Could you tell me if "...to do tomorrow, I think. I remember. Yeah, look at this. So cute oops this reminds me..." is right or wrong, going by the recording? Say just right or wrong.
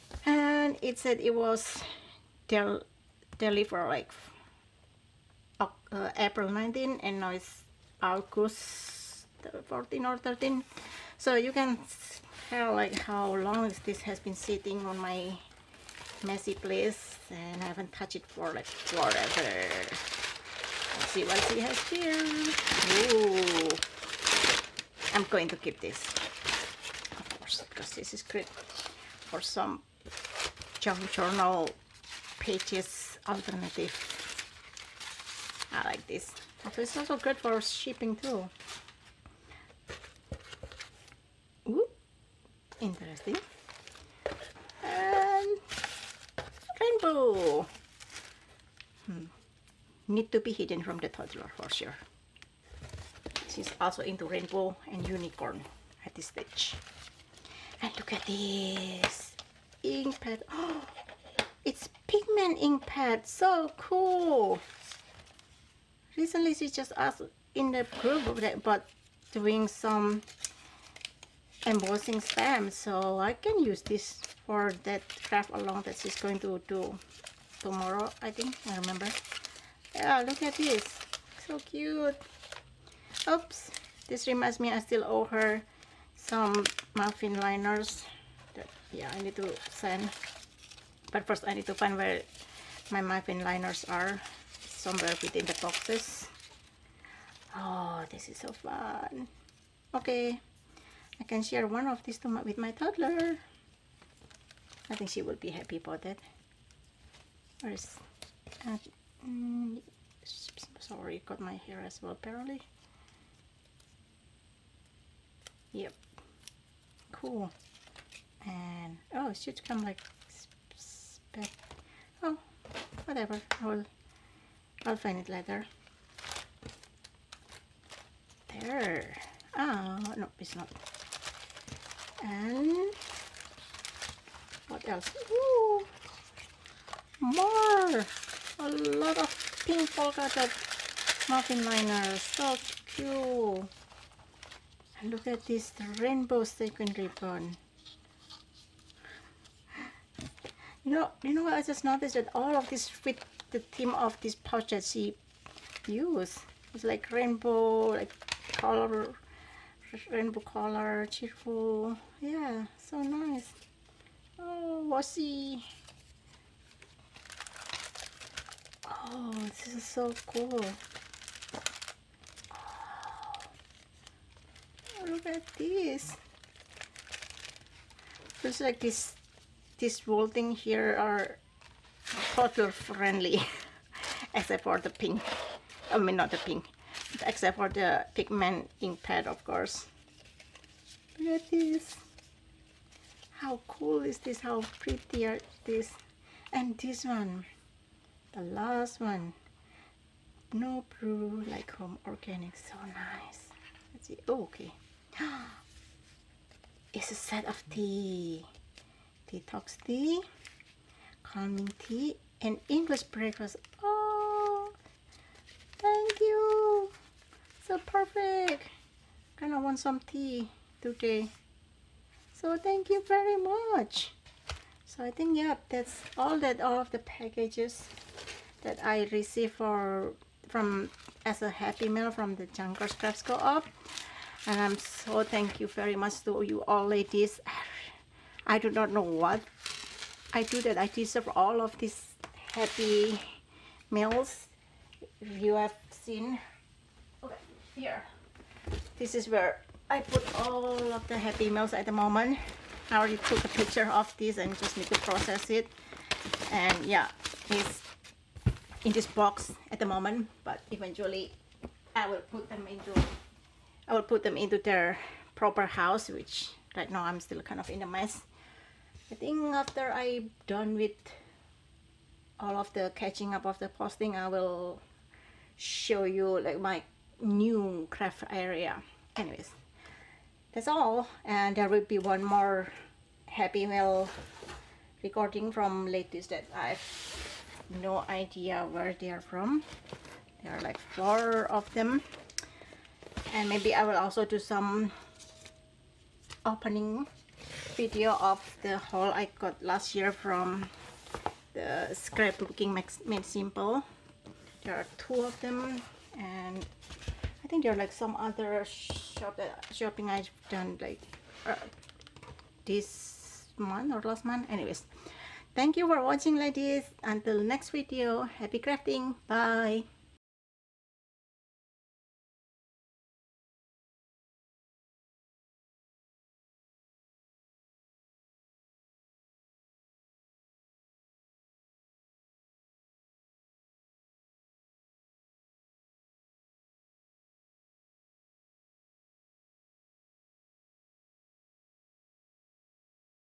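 right.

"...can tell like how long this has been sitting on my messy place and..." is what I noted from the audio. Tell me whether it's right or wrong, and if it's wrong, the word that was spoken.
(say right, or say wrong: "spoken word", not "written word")
right.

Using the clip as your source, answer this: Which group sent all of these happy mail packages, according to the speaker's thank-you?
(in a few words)
Junkers Crafts Co-op.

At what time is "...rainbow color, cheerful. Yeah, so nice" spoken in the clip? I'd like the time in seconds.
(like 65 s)
160 s.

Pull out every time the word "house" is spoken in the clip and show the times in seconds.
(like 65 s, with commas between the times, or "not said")
265 s.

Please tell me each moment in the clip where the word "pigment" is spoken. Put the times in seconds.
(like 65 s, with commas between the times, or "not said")
62 s, 188 s.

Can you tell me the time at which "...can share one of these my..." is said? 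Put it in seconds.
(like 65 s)
101 s.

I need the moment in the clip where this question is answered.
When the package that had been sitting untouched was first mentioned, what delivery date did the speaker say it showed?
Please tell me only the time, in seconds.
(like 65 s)
6 s.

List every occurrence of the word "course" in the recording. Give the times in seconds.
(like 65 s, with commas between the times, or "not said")
27 s, 189 s.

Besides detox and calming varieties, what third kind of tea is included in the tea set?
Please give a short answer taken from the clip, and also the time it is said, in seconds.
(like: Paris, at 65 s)
English breakfast, at 212 s.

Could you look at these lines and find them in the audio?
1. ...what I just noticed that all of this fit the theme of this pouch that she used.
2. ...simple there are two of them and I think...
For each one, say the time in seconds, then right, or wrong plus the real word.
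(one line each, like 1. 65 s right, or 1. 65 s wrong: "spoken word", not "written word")
1. 151 s right
2. 303 s right.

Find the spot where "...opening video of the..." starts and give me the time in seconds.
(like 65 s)
296 s.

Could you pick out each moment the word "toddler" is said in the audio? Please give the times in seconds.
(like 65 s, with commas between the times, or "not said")
51 s, 102 s, 182 s.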